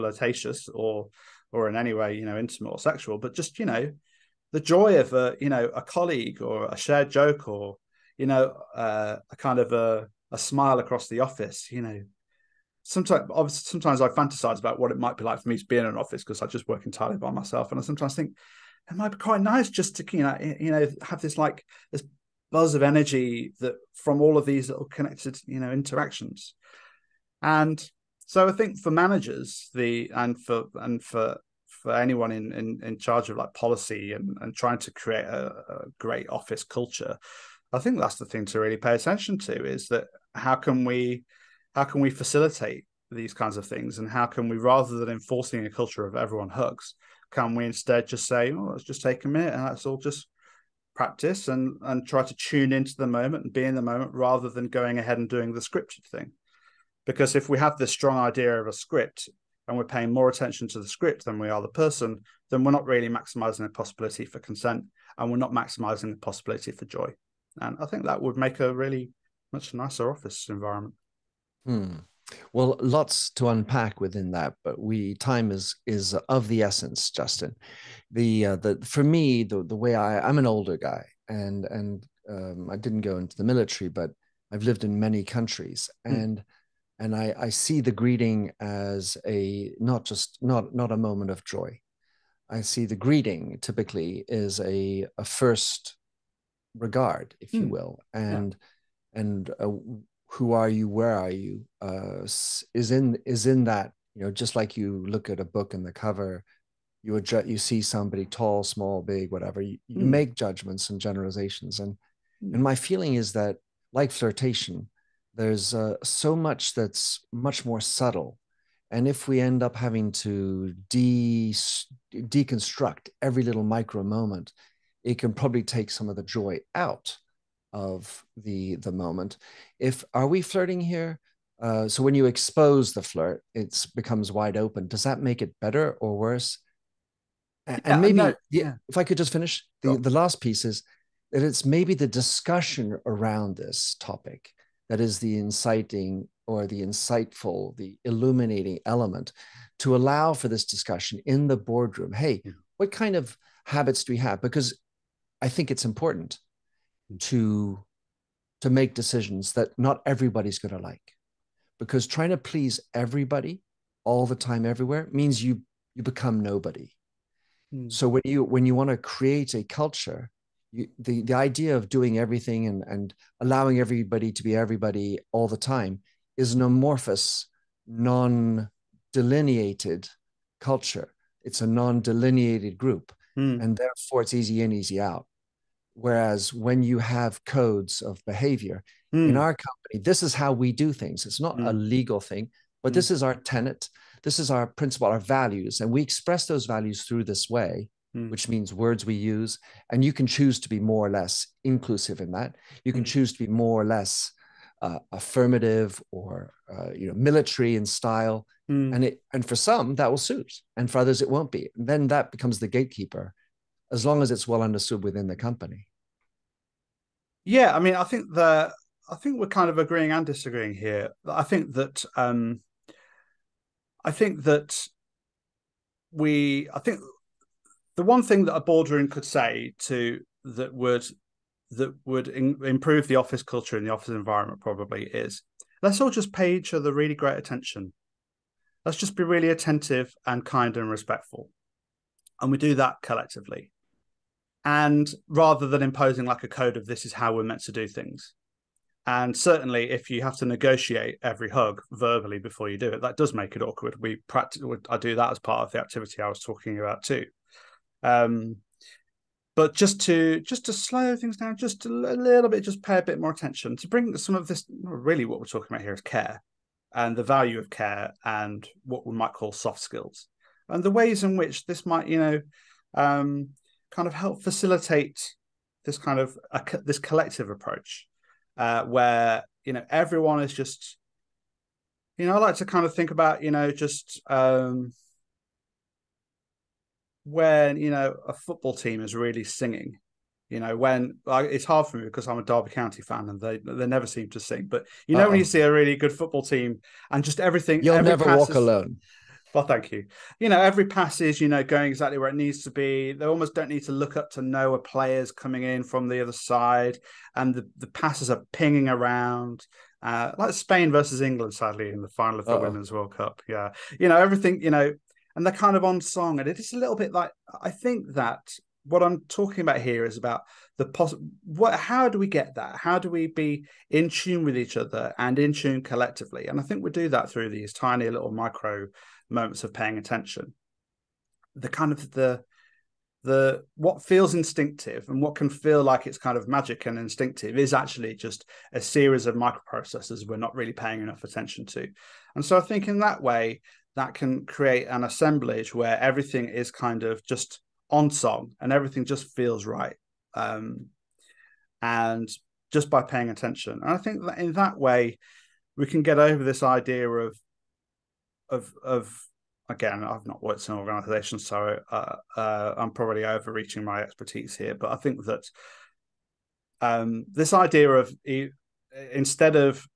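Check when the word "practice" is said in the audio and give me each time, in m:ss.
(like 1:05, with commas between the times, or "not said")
0:50, 4:14.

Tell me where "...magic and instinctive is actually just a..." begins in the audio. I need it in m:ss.
5:36.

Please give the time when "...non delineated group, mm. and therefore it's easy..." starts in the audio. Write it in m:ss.
3:01.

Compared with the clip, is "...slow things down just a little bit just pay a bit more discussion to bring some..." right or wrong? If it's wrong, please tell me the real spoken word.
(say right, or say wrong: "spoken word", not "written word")
wrong: "attention", not "discussion".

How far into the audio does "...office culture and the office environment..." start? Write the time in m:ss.
3:53.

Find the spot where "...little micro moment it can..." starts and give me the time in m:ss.
2:03.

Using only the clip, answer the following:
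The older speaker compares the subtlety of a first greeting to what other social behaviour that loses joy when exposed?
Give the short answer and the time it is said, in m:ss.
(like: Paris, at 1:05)
flirtation, at 1:54.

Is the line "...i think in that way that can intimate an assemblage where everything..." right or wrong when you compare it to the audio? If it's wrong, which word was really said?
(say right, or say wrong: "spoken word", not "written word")
wrong: "create", not "intimate".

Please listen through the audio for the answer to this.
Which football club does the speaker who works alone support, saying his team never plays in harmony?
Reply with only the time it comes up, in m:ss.
4:52.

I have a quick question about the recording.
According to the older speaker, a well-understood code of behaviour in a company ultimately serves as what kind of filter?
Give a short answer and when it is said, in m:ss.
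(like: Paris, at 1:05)
the gatekeeper, at 3:32.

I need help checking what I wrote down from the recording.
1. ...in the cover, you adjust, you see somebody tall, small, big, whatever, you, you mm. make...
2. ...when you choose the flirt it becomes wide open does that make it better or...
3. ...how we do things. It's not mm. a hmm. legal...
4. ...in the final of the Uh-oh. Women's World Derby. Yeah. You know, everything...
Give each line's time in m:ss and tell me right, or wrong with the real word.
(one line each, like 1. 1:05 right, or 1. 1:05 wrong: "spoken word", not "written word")
1. 1:45 right
2. 2:12 wrong: "expose", not "choose"
3. 3:10 right
4. 5:11 wrong: "Cup", not "Derby".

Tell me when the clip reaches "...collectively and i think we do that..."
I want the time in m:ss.
5:25.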